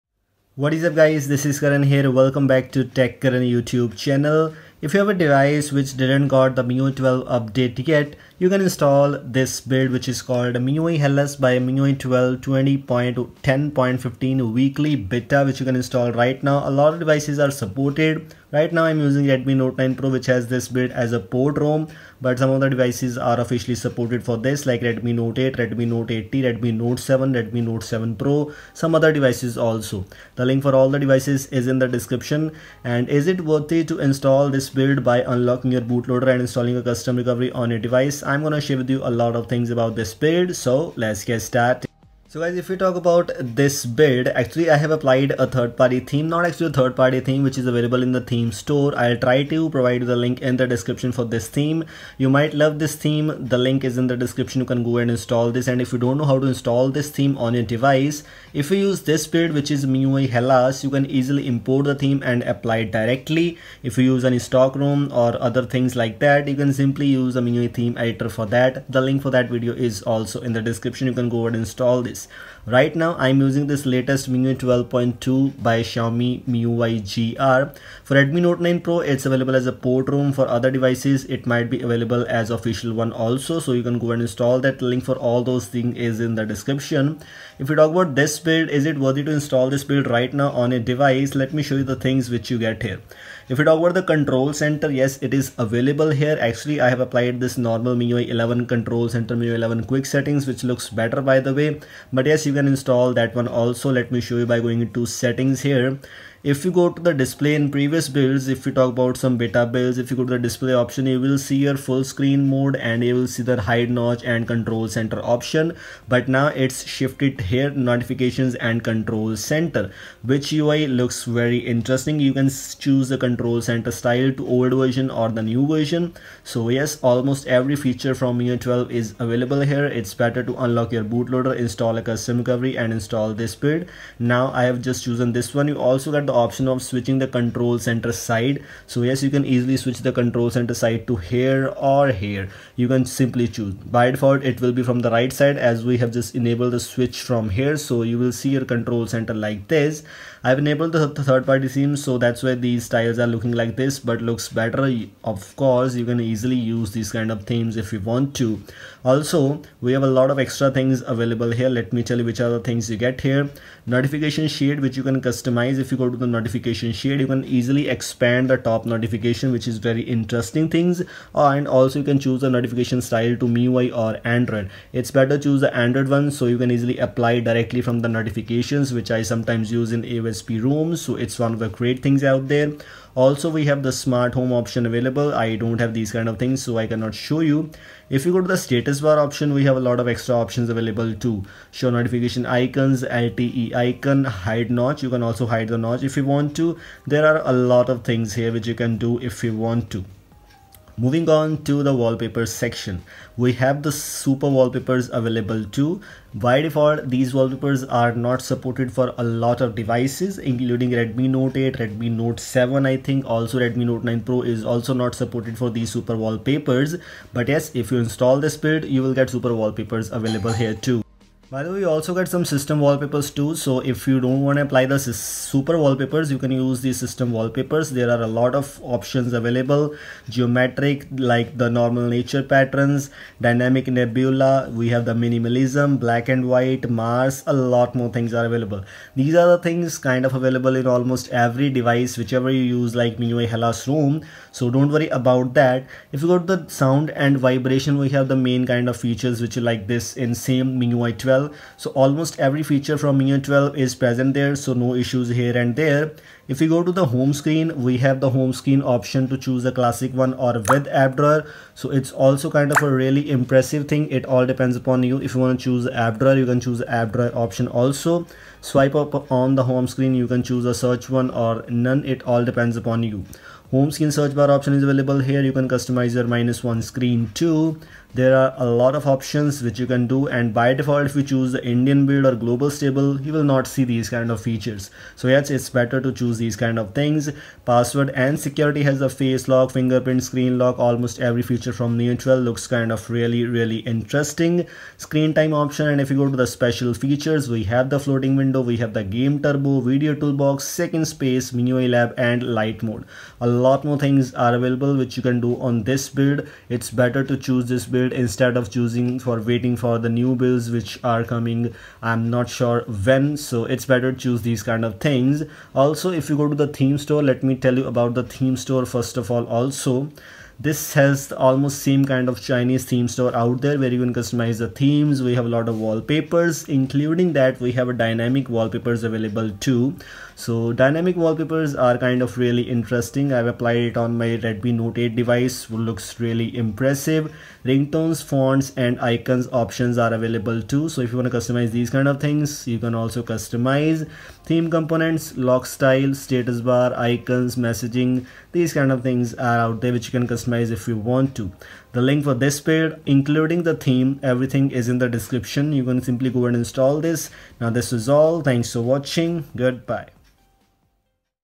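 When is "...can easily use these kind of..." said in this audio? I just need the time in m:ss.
2:36.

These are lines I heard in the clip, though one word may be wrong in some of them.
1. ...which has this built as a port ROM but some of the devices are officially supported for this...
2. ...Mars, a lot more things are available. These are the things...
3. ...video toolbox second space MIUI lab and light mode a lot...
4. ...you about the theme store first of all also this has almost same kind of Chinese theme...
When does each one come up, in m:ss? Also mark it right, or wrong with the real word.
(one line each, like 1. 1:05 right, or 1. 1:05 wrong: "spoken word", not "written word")
1. 0:20 right
2. 3:56 right
3. 4:59 right
4. 5:17 right.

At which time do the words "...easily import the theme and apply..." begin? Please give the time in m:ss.
1:01.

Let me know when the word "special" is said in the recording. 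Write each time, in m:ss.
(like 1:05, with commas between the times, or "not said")
4:56.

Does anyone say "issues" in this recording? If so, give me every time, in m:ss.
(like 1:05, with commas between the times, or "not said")
4:15.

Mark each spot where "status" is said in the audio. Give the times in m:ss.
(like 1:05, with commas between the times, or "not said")
3:08, 5:46.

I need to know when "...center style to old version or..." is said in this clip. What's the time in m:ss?
2:03.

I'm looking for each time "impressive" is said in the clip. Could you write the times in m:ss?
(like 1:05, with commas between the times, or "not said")
4:23, 5:36.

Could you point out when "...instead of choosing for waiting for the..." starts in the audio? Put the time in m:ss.
5:08.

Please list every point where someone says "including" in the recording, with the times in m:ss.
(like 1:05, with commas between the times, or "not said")
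3:30, 5:26, 5:53.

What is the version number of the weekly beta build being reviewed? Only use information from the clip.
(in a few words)
20.10.15.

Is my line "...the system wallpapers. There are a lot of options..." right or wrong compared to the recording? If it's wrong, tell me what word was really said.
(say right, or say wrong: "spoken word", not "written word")
right.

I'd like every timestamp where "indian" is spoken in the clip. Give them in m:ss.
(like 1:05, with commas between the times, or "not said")
4:41.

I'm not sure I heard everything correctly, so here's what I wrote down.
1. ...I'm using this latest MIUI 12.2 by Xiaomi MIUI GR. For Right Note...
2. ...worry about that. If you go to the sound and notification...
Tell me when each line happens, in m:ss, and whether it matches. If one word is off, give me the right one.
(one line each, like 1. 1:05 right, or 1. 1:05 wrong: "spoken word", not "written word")
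1. 1:13 wrong: "Redmi", not "Right"
2. 4:04 wrong: "vibration", not "notification".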